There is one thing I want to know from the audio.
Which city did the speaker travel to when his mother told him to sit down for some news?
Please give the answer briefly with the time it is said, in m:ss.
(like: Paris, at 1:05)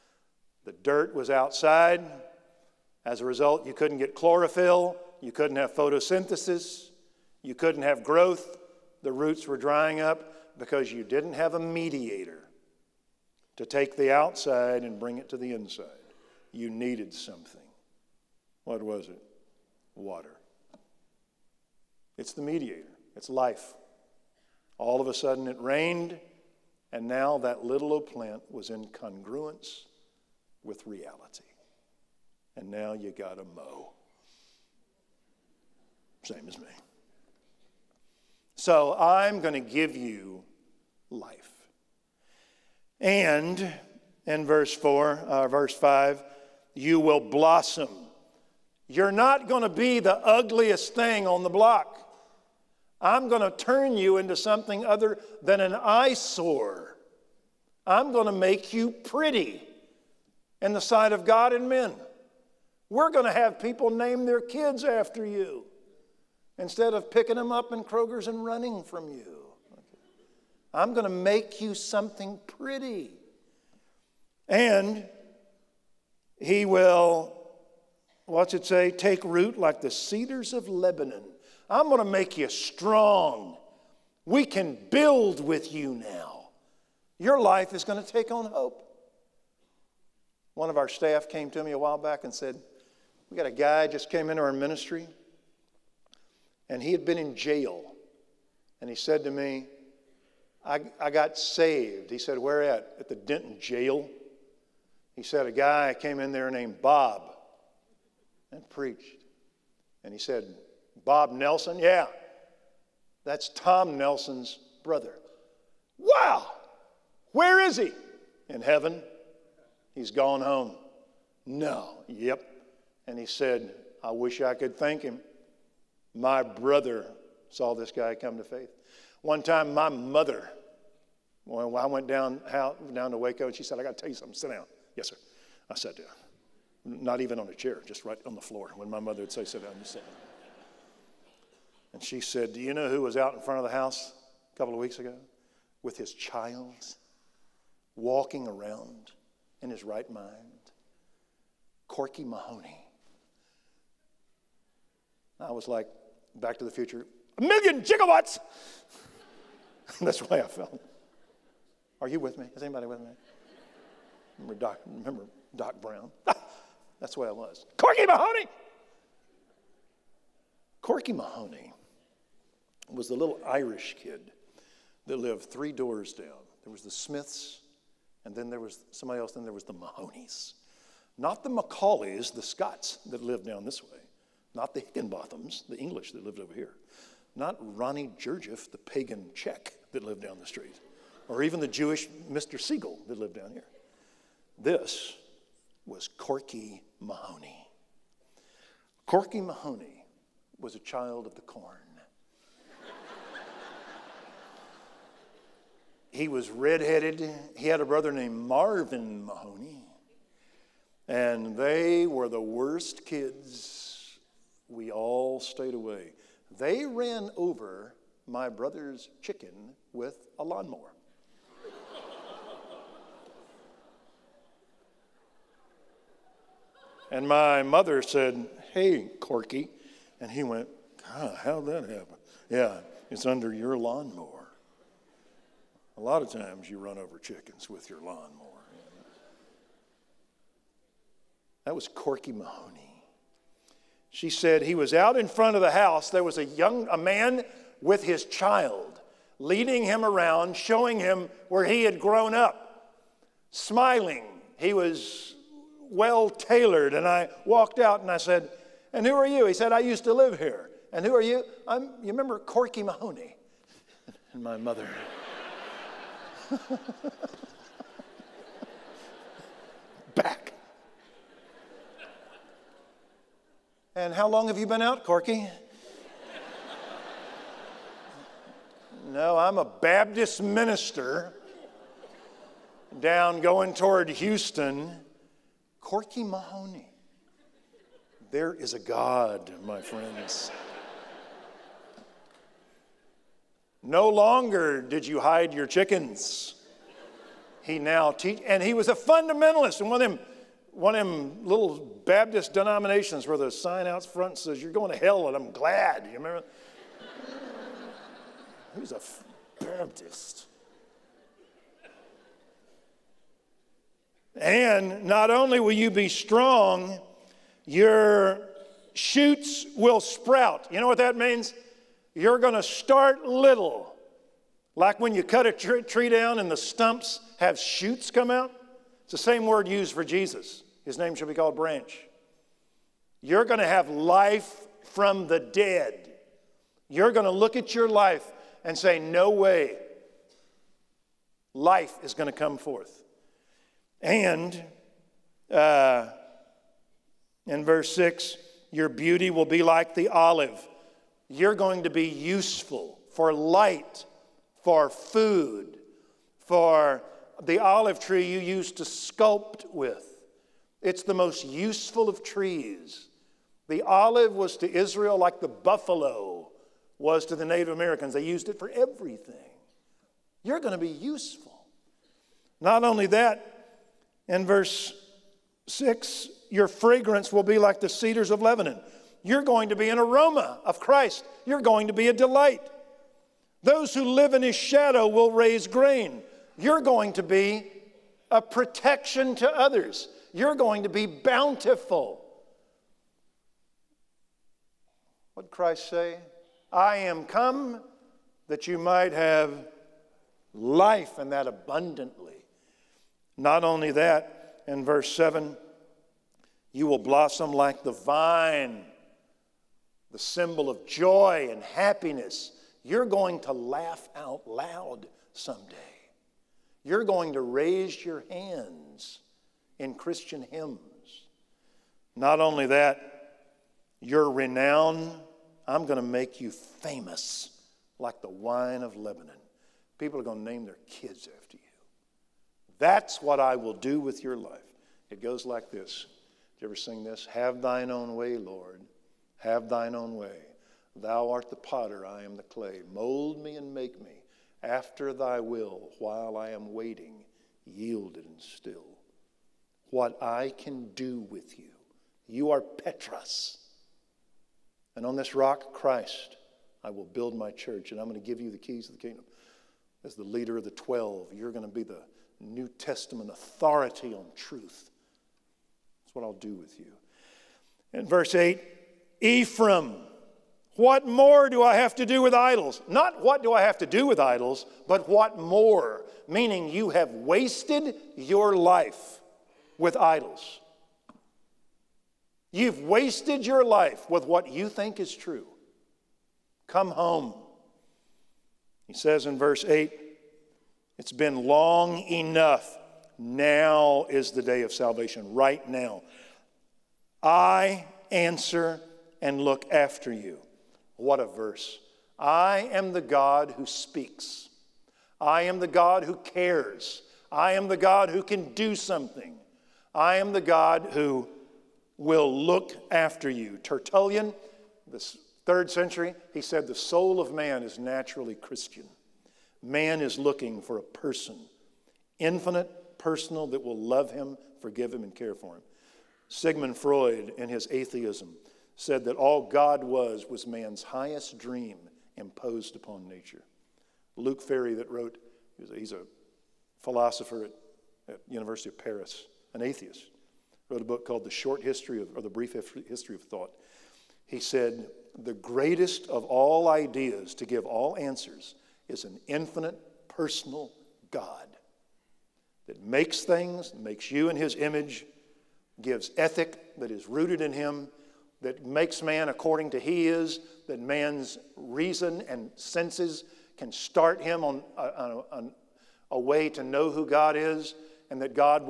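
Waco, at 2:13.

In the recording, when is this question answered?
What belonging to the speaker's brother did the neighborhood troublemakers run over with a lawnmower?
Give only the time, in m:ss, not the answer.
3:39.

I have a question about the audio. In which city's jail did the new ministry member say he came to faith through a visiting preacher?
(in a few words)
Denton.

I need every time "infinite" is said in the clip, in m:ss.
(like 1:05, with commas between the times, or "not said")
8:42, 9:09.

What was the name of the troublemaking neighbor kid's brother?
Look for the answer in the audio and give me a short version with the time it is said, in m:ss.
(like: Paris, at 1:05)
Marvin Mahoney, at 3:28.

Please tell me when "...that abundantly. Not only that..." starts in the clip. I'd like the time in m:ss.
6:41.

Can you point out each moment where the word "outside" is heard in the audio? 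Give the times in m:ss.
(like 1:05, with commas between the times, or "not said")
0:01, 0:14.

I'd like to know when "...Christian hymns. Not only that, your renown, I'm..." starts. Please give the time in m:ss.
6:59.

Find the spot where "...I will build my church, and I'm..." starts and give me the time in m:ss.
7:36.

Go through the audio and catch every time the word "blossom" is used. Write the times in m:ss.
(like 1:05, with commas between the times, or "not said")
0:47, 6:46.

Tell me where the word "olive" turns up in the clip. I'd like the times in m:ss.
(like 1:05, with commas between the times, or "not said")
5:50, 5:57, 6:03.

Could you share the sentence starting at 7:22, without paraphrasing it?
Mold me and make me after thy will while I am waiting, yielded and still what I can do with you.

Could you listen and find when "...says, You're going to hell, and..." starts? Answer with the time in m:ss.
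5:04.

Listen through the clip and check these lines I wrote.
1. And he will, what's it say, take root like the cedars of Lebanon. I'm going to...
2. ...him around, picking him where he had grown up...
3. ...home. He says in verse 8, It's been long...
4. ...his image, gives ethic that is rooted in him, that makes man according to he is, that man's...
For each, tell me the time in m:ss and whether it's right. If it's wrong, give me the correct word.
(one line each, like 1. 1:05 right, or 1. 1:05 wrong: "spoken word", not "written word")
1. 1:14 right
2. 4:09 wrong: "showing", not "picking"
3. 8:06 right
4. 9:14 right.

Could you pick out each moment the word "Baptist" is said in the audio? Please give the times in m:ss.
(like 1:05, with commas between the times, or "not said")
4:39, 5:02, 5:09.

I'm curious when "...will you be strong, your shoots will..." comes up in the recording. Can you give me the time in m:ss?
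5:15.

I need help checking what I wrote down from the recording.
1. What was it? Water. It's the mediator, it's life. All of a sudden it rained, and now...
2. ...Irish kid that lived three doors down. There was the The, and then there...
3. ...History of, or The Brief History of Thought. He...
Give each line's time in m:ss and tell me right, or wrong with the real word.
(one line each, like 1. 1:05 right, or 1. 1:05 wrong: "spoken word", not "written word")
1. 0:18 right
2. 2:53 wrong: "Smiths", not "The"
3. 9:01 right.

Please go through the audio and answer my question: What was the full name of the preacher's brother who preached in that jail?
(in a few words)
Bob Nelson.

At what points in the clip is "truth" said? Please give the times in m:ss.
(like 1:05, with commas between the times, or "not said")
7:44.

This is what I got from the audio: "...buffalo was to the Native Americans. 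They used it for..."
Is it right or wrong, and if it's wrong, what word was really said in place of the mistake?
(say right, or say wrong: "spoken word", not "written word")
right.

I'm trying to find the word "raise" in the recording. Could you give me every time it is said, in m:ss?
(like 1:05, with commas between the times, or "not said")
6:25, 6:57.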